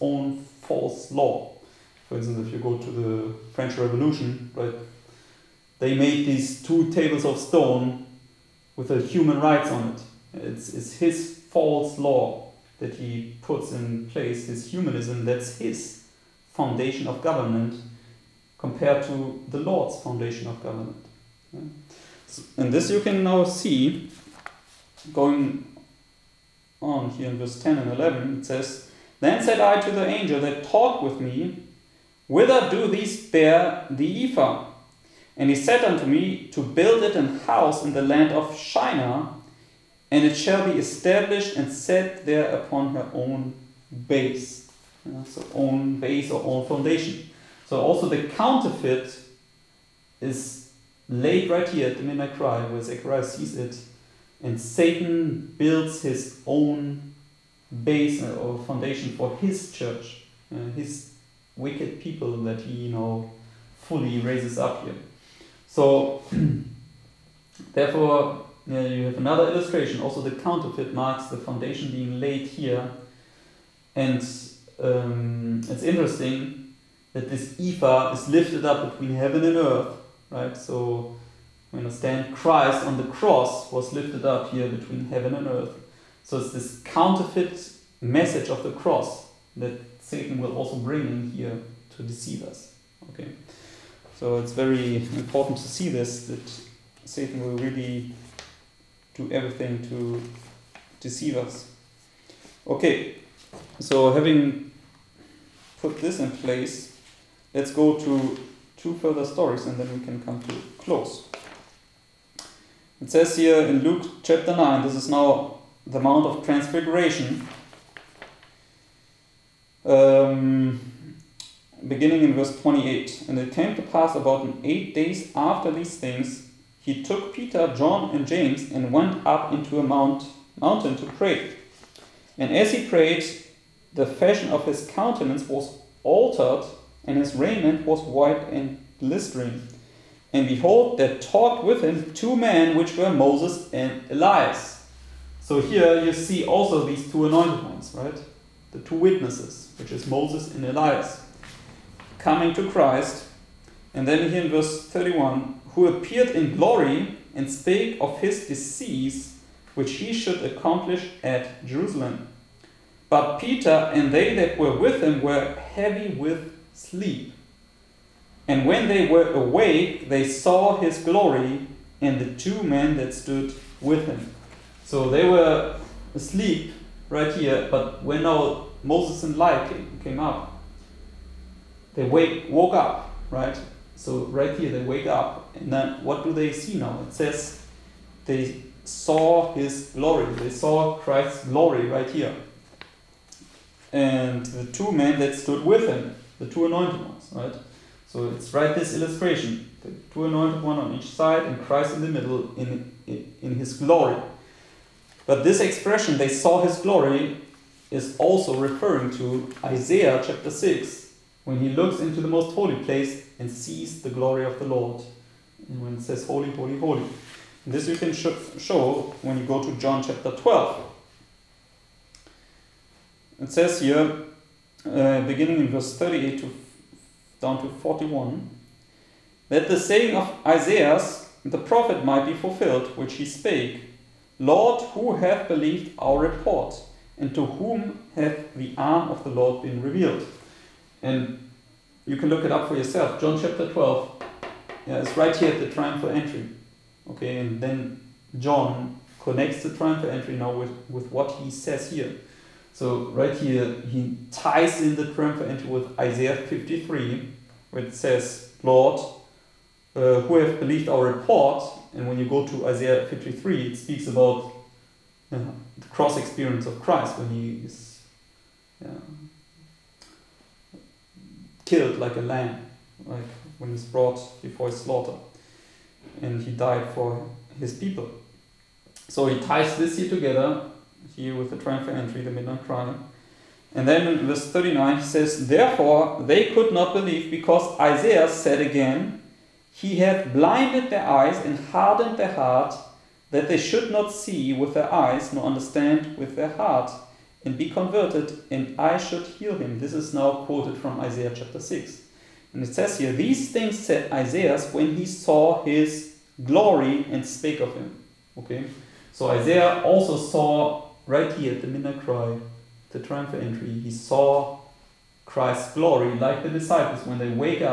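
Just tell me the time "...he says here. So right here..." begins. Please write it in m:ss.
4:11.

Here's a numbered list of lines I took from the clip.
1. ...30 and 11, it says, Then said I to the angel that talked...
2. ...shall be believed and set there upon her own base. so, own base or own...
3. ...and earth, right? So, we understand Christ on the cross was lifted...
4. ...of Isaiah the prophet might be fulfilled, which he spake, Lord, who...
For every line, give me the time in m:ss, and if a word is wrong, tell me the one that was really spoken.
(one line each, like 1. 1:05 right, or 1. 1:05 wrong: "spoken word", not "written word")
1. 0:27 wrong: "10", not "30"
2. 0:40 wrong: "established", not "believed"
3. 1:19 right
4. 3:50 right.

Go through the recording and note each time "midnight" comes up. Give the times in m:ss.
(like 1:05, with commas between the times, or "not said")
0:52, 4:42, 5:11.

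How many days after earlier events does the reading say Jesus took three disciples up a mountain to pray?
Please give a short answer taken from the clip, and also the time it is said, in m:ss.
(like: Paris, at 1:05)
8, at 2:04.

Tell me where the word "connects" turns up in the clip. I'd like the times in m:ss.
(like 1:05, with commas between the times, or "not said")
4:09.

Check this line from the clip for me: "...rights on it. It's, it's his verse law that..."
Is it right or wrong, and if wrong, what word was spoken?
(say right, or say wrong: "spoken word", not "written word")
wrong: "false", not "verse".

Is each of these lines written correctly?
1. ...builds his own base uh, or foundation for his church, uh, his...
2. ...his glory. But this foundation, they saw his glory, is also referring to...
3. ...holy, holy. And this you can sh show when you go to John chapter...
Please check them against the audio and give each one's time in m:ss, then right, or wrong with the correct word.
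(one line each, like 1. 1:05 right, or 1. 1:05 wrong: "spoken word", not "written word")
1. 0:55 right
2. 3:23 wrong: "expression", not "foundation"
3. 3:36 right.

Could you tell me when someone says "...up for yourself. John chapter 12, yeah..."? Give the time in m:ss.
4:02.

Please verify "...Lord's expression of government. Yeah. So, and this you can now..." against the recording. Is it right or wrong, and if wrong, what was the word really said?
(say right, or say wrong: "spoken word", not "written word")
wrong: "foundation", not "expression".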